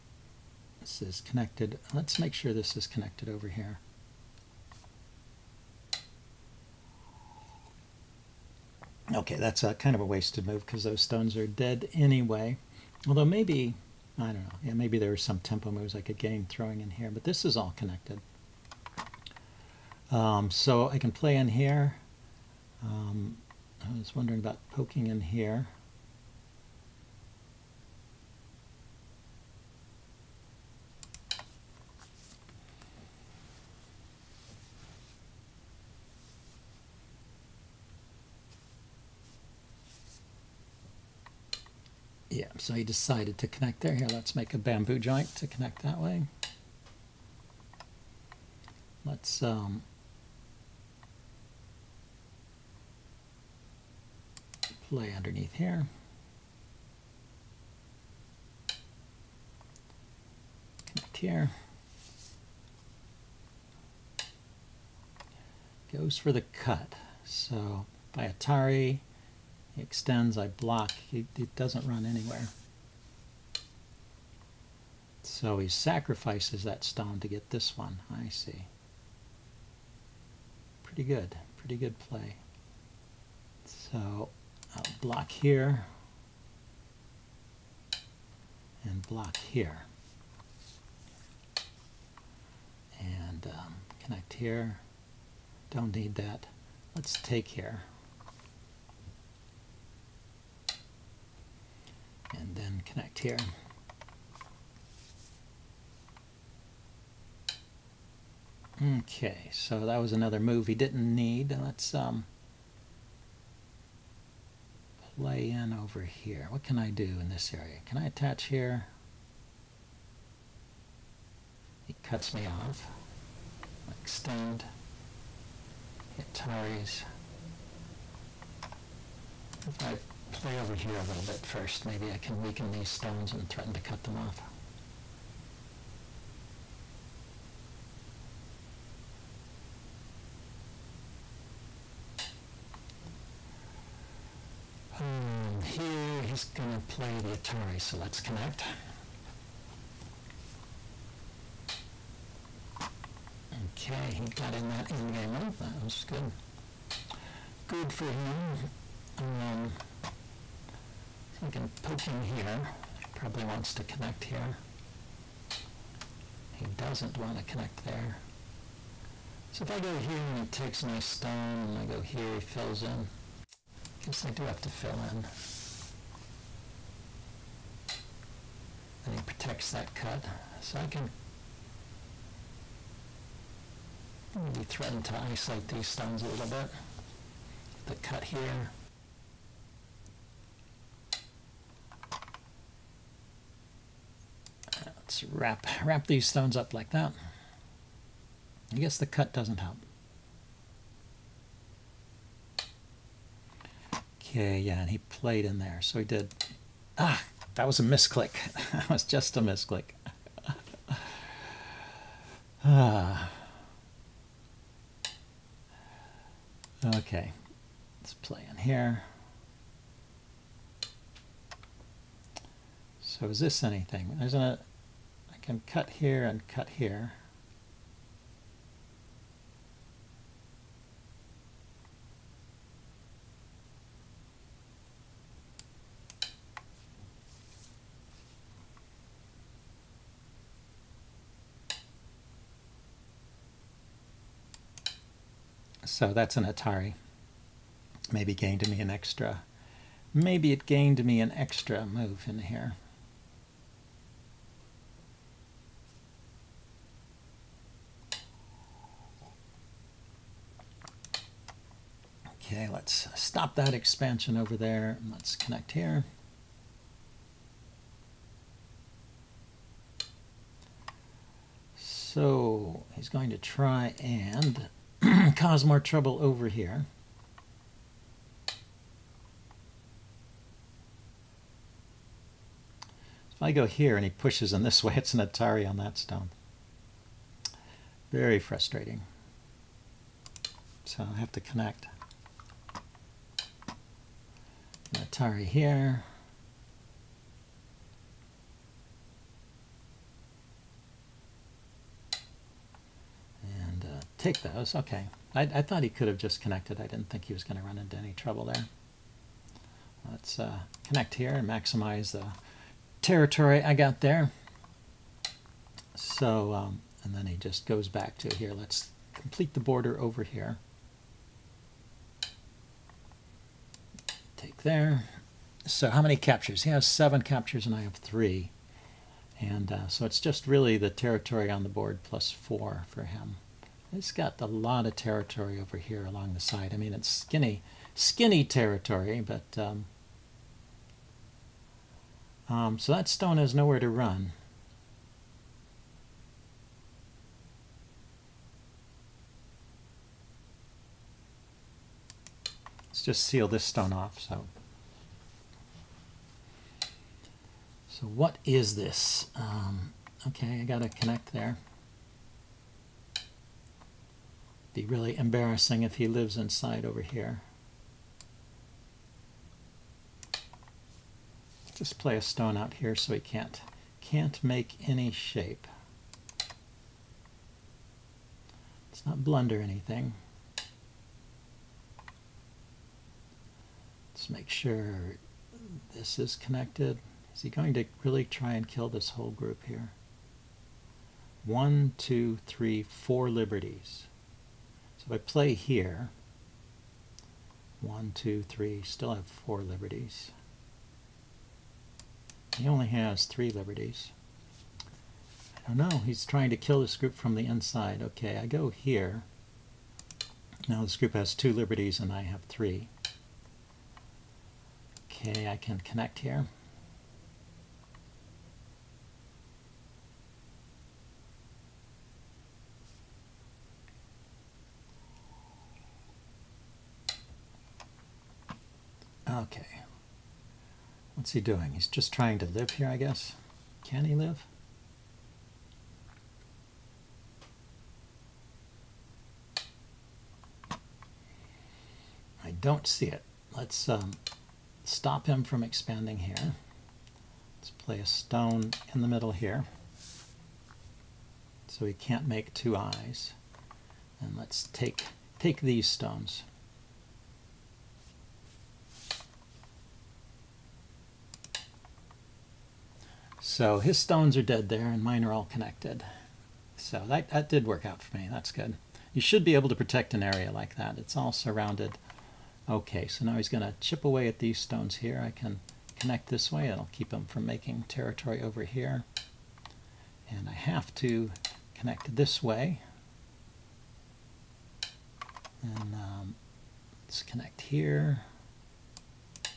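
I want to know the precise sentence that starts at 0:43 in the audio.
Here, let's make a bamboo joint to connect that way.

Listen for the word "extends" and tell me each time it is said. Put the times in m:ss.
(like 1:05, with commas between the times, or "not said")
1:09, 2:04.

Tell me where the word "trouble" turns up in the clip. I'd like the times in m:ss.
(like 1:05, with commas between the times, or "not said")
4:35, 5:08.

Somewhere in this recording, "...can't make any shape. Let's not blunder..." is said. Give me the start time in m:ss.
6:14.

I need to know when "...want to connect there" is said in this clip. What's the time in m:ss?
2:47.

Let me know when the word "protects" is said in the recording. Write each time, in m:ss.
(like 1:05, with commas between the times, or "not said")
2:59, 7:49.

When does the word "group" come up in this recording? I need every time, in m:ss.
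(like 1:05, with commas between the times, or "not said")
6:29, 6:46, 6:50.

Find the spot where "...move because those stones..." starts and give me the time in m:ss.
0:10.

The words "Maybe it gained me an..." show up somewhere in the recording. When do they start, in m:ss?
4:10.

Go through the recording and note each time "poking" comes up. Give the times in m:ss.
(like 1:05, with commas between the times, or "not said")
0:24.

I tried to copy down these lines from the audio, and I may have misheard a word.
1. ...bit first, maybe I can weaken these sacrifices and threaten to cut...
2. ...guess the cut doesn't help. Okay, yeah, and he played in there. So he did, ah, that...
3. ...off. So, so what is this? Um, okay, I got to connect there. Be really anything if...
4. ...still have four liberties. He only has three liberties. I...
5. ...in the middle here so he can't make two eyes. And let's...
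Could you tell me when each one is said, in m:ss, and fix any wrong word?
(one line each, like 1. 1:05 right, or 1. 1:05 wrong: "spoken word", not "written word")
1. 2:11 wrong: "stones", not "sacrifices"
2. 3:18 right
3. 5:53 wrong: "embarrassing", not "anything"
4. 6:38 right
5. 7:28 right.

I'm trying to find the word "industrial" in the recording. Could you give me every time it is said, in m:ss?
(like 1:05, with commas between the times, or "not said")
not said.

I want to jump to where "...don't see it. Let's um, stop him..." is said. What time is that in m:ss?
7:22.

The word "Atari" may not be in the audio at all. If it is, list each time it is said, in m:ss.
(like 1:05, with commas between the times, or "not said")
1:08, 2:27, 4:06, 4:45, 4:55.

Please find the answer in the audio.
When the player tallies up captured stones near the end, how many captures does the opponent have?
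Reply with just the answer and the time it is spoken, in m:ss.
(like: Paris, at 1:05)
7, at 5:26.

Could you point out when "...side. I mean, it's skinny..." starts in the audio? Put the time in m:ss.
5:36.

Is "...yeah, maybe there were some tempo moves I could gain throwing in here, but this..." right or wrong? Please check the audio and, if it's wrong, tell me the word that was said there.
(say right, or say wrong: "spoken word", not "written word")
right.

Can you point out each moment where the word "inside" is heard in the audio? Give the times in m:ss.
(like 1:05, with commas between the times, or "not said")
6:06, 6:47.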